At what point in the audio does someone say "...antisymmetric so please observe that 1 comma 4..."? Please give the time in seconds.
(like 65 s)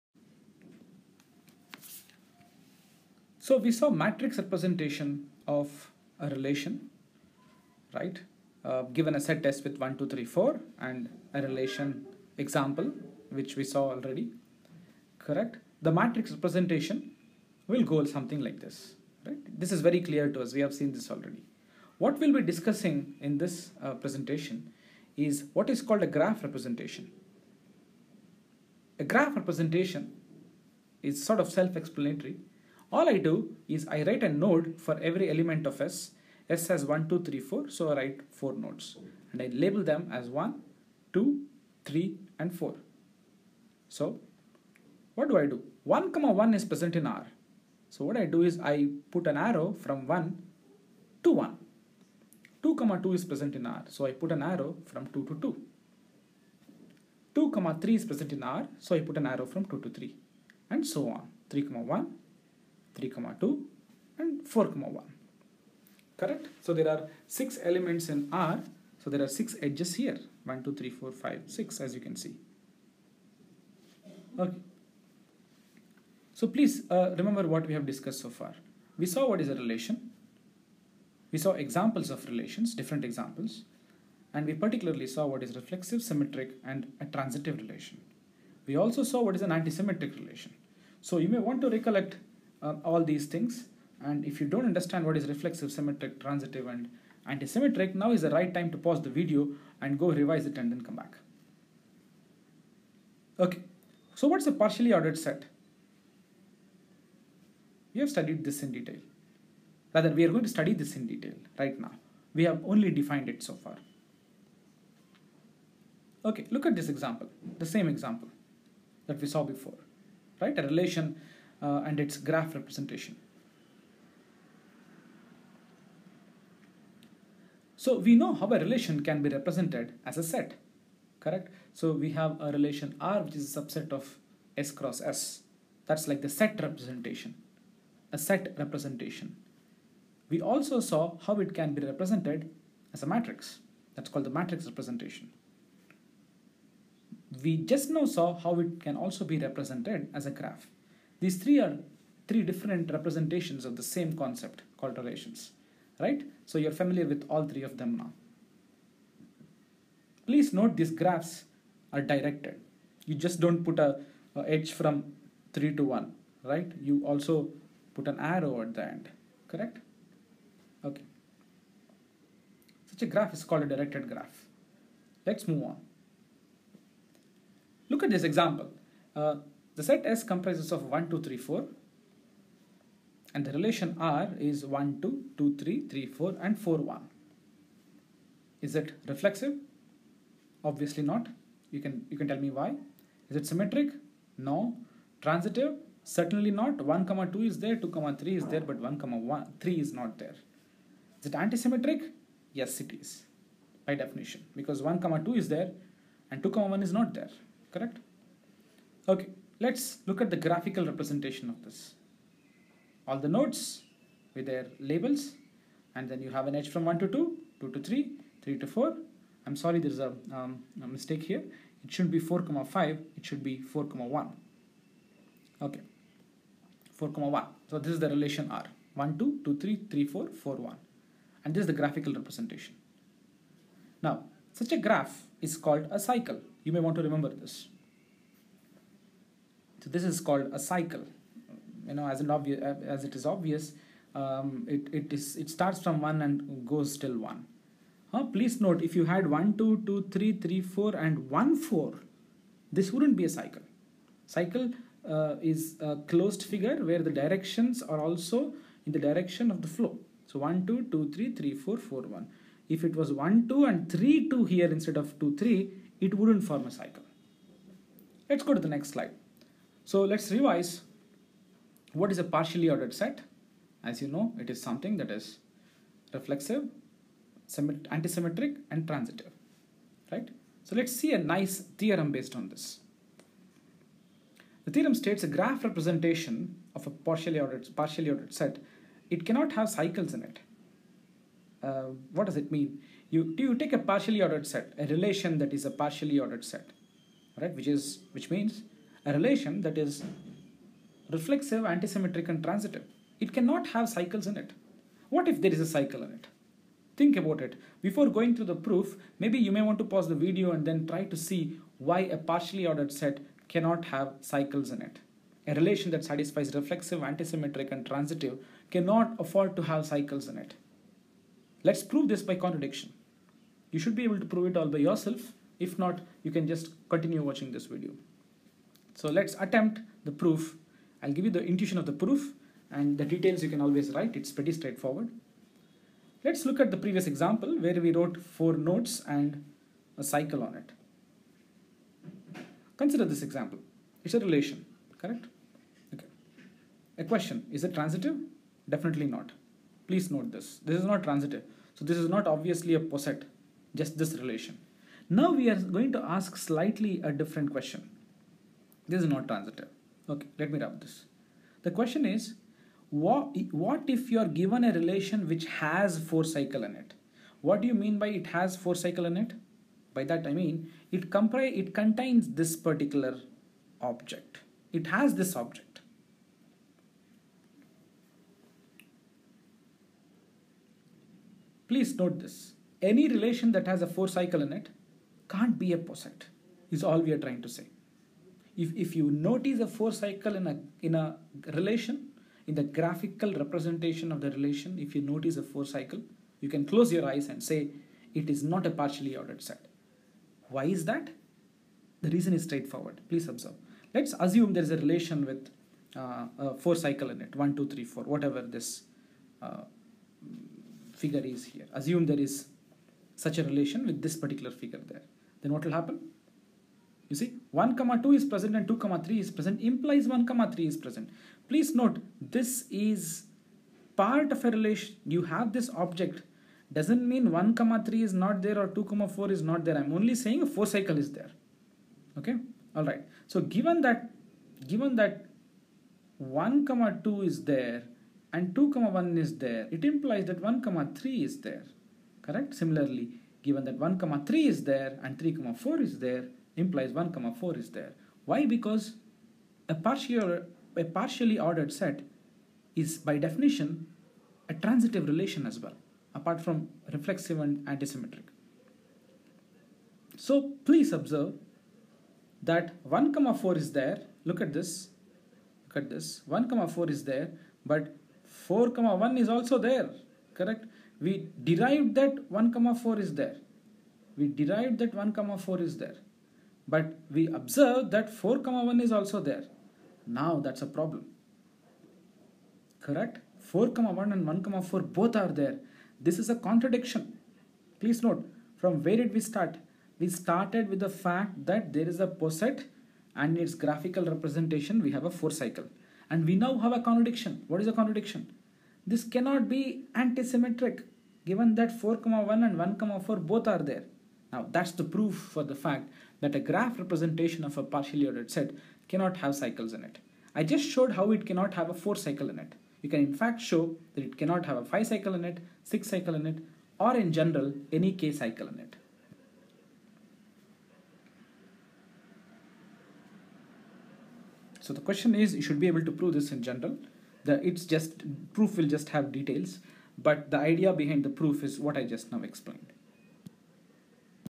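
457 s.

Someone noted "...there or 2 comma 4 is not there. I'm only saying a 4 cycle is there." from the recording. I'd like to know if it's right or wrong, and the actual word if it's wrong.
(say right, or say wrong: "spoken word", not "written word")
right.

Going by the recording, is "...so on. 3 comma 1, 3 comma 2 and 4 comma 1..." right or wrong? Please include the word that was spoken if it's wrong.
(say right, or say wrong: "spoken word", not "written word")
right.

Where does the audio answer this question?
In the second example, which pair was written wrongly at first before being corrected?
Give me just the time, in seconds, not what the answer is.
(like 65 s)
222 s.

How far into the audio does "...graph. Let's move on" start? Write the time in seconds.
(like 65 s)
174 s.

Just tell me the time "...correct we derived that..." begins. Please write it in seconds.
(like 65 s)
470 s.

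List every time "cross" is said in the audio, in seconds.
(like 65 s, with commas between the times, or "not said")
134 s.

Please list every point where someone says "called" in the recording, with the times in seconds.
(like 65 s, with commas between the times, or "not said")
25 s, 144 s, 154 s, 173 s, 235 s, 240 s.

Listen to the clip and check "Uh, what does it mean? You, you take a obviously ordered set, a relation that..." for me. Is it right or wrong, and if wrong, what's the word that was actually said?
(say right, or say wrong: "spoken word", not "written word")
wrong: "partially", not "obviously".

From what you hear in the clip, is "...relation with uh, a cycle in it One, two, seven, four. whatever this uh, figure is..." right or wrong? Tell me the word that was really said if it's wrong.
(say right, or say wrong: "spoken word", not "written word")
wrong: "three", not "seven".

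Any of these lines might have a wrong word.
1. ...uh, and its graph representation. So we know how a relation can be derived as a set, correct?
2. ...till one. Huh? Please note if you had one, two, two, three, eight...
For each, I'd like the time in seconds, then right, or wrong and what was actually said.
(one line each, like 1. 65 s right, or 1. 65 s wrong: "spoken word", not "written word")
1. 121 s wrong: "represented", not "derived"
2. 246 s wrong: "three", not "eight".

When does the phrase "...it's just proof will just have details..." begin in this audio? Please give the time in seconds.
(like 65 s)
527 s.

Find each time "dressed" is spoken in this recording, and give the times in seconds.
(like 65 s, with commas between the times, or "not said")
not said.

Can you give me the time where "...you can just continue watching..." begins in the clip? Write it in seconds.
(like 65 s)
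326 s.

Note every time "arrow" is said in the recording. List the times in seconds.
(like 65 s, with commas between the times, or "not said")
49 s, 54 s, 59 s, 168 s.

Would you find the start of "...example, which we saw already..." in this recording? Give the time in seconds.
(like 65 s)
12 s.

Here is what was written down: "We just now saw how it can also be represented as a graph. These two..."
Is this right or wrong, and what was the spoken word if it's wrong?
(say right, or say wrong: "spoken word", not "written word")
wrong: "three", not "two".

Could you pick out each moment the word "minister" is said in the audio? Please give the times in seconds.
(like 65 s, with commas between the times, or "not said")
not said.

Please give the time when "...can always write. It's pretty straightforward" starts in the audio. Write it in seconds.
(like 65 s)
333 s.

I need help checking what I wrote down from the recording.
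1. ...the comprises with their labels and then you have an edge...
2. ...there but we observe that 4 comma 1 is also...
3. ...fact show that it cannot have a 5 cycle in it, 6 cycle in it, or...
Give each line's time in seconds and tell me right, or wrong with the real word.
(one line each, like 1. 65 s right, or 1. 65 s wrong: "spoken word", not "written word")
1. 213 s wrong: "nodes", not "comprises"
2. 475 s right
3. 513 s right.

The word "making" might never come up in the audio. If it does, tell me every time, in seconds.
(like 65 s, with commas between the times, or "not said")
not said.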